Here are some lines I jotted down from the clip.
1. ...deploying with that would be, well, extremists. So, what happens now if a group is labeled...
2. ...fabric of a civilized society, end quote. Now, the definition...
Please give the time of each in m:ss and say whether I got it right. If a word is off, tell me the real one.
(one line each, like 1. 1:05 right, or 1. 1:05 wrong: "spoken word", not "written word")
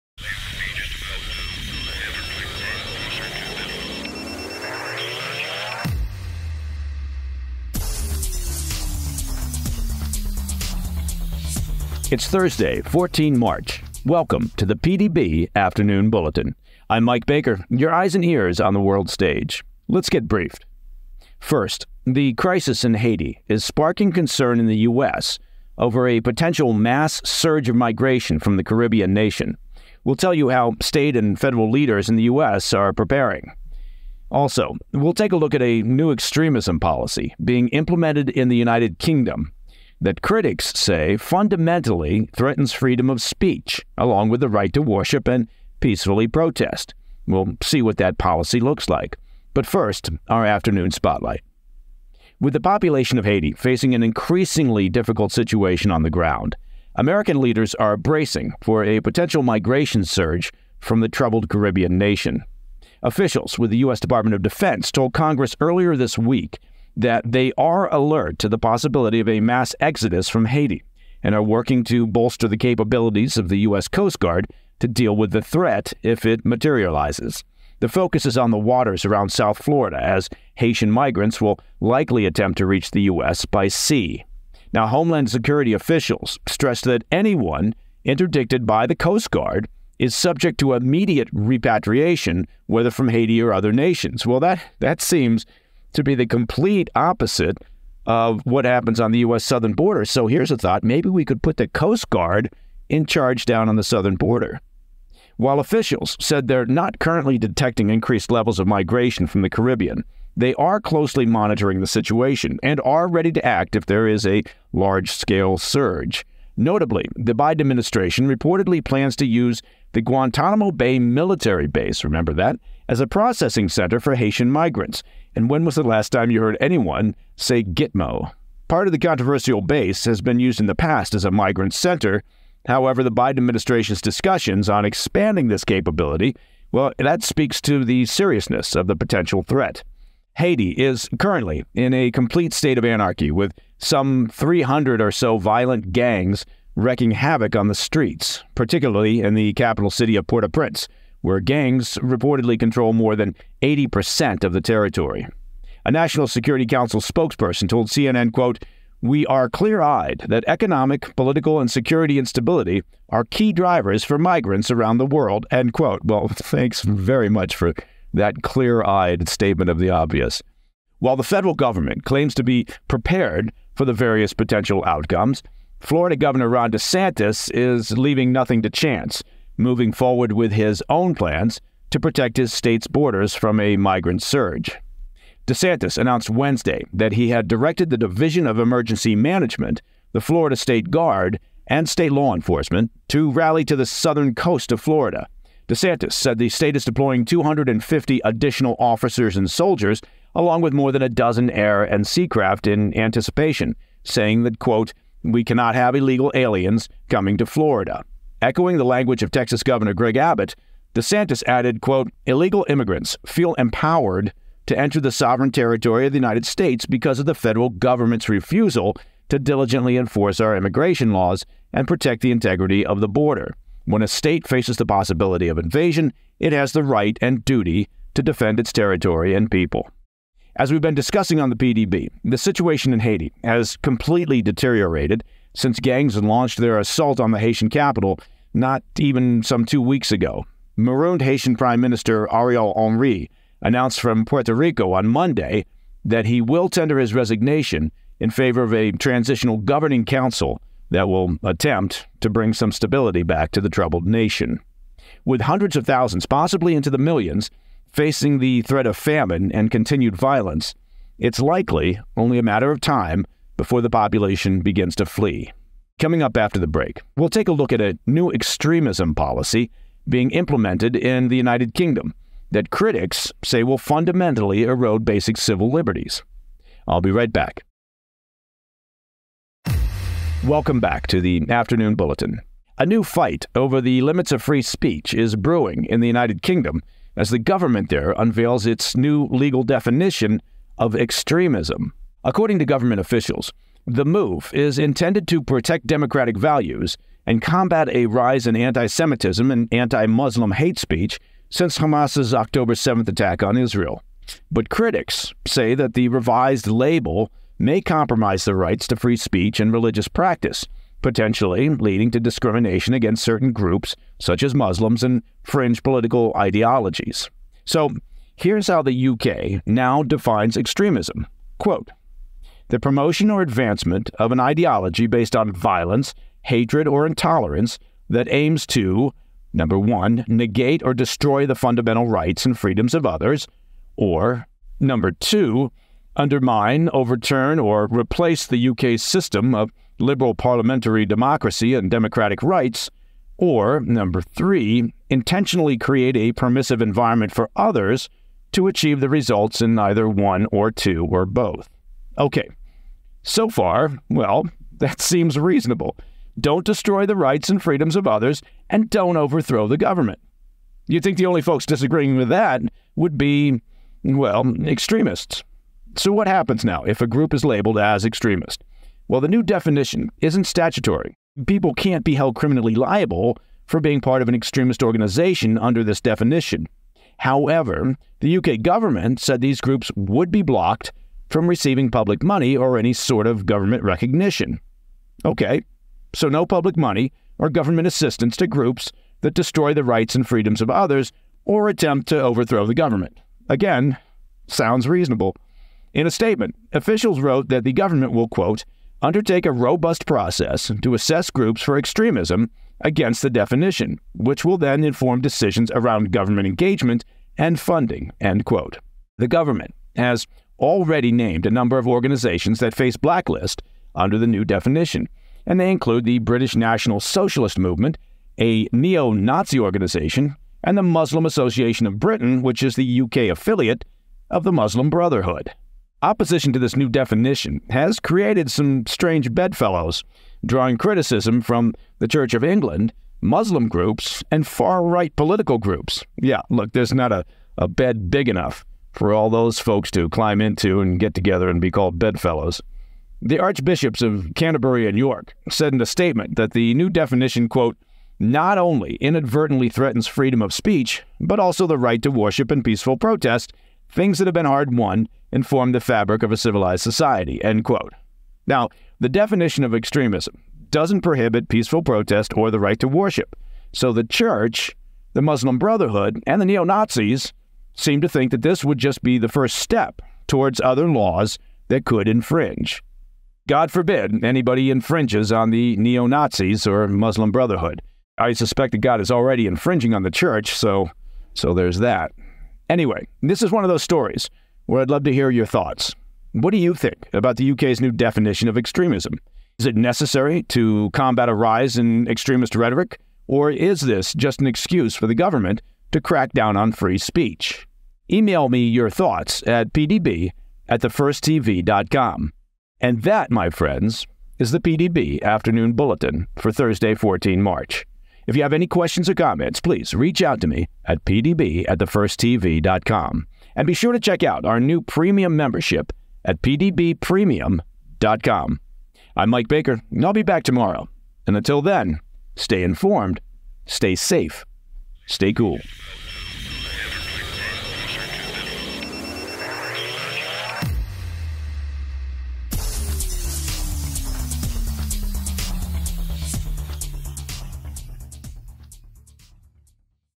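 1. 6:01 wrong: "disagreeing", not "deploying"
2. 7:35 right.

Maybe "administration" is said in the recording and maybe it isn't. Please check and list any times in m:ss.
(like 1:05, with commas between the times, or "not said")
1:57, 2:13.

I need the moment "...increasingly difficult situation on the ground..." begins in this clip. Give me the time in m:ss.
0:54.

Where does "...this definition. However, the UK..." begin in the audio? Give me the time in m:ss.
6:15.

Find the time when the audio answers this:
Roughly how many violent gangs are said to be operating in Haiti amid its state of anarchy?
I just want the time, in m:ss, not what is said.
2:24.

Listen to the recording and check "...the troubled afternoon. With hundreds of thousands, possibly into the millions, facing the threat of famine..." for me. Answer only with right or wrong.
wrong.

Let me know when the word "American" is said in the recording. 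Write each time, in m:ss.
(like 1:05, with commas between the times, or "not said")
0:56.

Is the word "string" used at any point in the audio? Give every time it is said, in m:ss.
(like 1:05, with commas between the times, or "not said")
not said.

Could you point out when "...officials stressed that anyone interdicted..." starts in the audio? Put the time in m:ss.
1:25.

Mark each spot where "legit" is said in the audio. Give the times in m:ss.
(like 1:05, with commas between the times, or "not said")
not said.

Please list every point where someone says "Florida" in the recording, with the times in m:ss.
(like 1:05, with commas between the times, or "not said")
1:19, 2:55, 3:10, 3:14, 3:27.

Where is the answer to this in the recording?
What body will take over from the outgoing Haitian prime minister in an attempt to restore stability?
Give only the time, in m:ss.
4:08.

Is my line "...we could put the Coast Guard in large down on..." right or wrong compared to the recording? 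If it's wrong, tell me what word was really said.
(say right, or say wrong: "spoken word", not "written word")
wrong: "charge", not "large".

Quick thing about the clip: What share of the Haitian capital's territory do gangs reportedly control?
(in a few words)
more than 80%.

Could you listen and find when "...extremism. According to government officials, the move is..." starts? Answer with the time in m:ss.
4:50.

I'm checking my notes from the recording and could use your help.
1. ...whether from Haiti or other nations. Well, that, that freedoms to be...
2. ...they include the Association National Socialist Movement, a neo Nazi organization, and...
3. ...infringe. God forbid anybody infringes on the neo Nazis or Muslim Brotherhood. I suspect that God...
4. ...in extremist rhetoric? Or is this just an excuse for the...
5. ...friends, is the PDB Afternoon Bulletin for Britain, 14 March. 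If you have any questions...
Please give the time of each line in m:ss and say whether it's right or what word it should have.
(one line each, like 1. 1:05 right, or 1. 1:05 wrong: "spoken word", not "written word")
1. 1:32 wrong: "seems", not "freedoms"
2. 6:55 wrong: "British", not "Association"
3. 7:52 right
4. 8:11 right
5. 8:23 wrong: "Thursday", not "Britain".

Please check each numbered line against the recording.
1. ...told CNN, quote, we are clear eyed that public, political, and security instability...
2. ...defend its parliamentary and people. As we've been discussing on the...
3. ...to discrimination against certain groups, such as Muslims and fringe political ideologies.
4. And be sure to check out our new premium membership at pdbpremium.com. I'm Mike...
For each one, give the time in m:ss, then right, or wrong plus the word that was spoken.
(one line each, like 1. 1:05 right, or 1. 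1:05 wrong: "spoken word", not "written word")
1. 2:37 wrong: "economic", not "public"
2. 3:48 wrong: "territory", not "parliamentary"
3. 5:12 right
4. 8:33 right.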